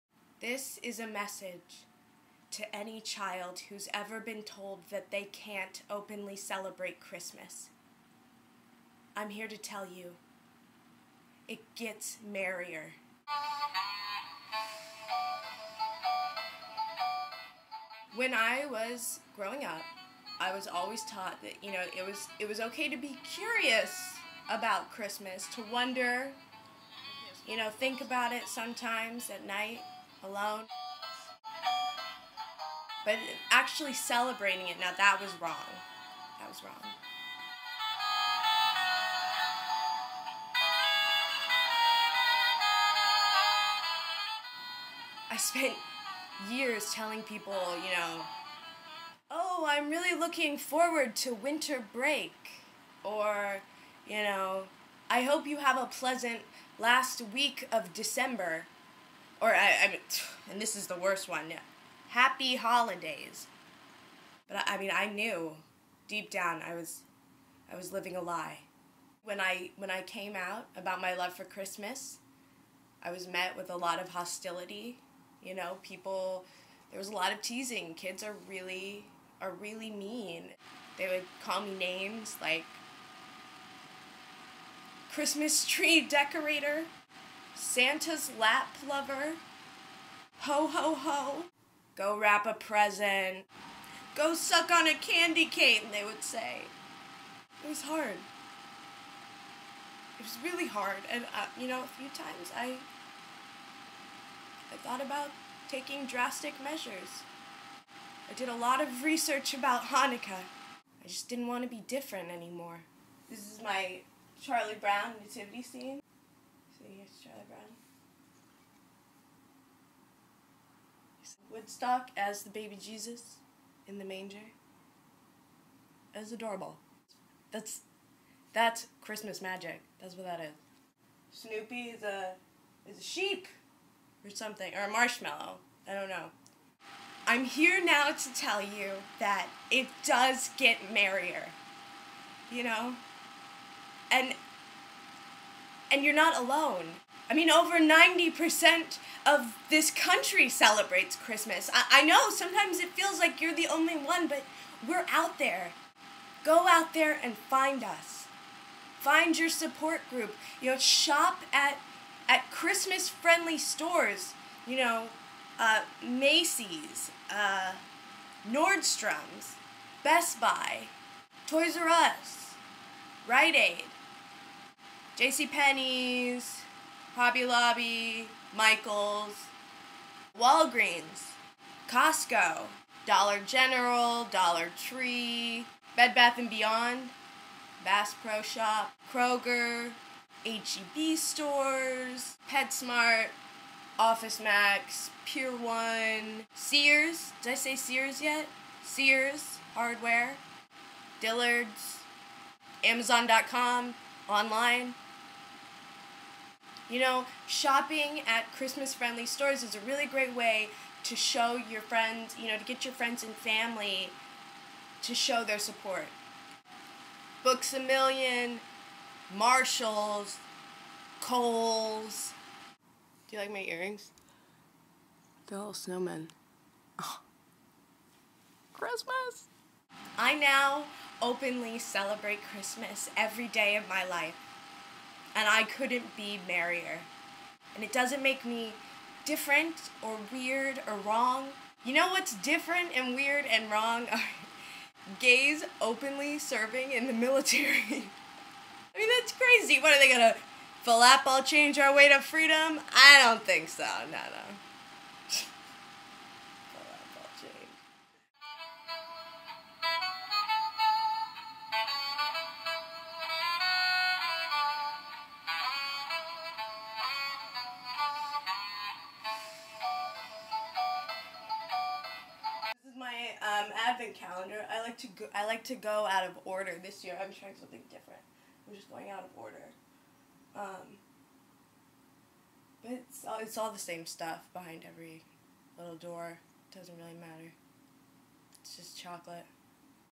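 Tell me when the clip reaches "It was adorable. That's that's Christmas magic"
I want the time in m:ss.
2:06.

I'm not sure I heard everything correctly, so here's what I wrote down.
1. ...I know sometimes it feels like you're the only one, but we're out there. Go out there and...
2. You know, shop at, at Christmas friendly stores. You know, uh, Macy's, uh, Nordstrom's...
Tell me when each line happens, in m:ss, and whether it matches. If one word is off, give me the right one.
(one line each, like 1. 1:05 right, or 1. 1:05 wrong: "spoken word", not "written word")
1. 2:31 right
2. 2:40 right.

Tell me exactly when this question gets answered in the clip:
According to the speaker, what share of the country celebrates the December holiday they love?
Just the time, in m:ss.
2:27.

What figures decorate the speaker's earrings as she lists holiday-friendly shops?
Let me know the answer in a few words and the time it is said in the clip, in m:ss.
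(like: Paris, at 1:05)
snowmen, at 3:45.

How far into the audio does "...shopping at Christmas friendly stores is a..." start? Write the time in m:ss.
3:27.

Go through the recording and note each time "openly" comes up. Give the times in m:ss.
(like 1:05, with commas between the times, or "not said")
0:05, 3:51, 4:05.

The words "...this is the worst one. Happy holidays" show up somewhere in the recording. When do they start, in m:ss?
1:00.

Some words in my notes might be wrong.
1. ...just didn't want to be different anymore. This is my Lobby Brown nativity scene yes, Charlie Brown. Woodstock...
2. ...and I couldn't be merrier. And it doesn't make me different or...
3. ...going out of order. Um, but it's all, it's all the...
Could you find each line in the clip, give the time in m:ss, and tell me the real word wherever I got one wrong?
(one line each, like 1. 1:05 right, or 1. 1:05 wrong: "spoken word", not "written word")
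1. 1:51 wrong: "Charlie", not "Lobby"
2. 3:55 right
3. 4:38 right.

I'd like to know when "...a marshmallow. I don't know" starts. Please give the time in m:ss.
2:14.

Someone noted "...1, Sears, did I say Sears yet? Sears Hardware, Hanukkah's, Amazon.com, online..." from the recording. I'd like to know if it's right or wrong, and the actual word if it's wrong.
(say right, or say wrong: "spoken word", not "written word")
wrong: "Dillard", not "Hanukkah".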